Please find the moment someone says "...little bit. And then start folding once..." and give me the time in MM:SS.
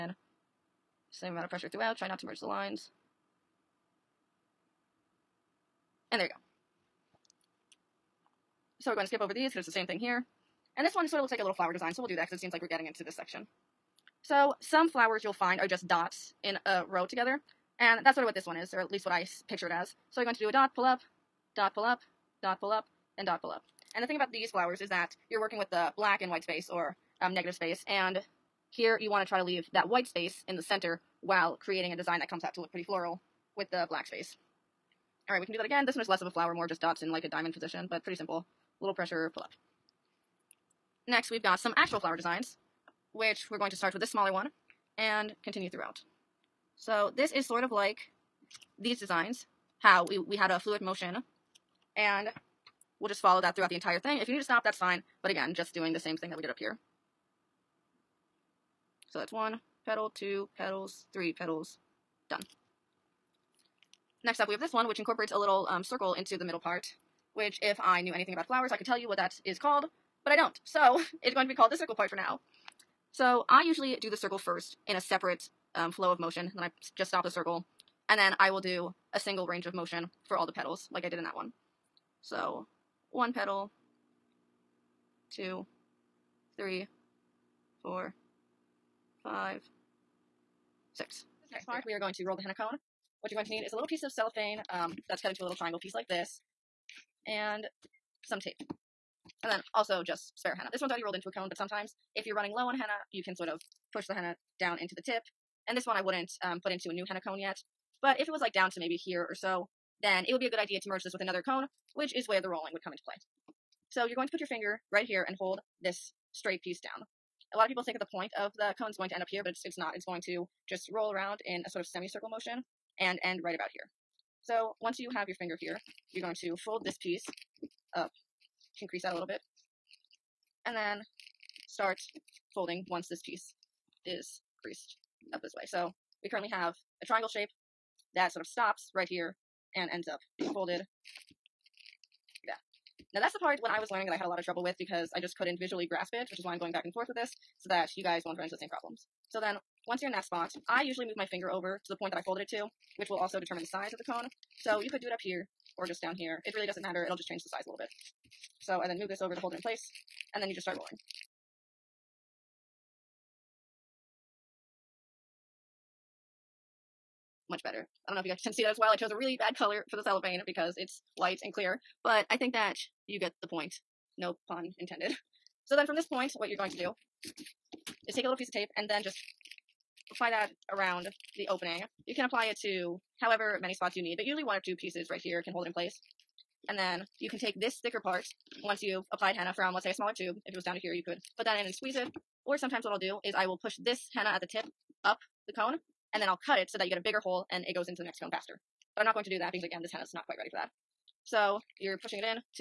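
02:09.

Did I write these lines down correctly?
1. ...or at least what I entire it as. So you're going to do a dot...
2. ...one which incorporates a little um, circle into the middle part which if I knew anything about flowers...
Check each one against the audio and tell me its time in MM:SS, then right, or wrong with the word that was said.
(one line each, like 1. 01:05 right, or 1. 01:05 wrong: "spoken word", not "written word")
1. 00:18 wrong: "picture", not "entire"
2. 01:04 right.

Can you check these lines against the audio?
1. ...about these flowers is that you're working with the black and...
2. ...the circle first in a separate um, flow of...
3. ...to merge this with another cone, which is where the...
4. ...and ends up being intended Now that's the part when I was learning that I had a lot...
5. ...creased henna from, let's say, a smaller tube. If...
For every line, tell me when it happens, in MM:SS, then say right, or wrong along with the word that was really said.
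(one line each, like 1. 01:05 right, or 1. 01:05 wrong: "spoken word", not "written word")
1. 00:24 right
2. 01:14 right
3. 01:50 right
4. 02:19 wrong: "folded", not "intended"
5. 03:09 wrong: "applied", not "creased".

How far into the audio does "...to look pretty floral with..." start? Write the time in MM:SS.
00:32.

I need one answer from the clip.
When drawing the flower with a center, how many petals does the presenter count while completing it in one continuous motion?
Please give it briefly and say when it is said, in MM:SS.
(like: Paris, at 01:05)
6, at 01:30.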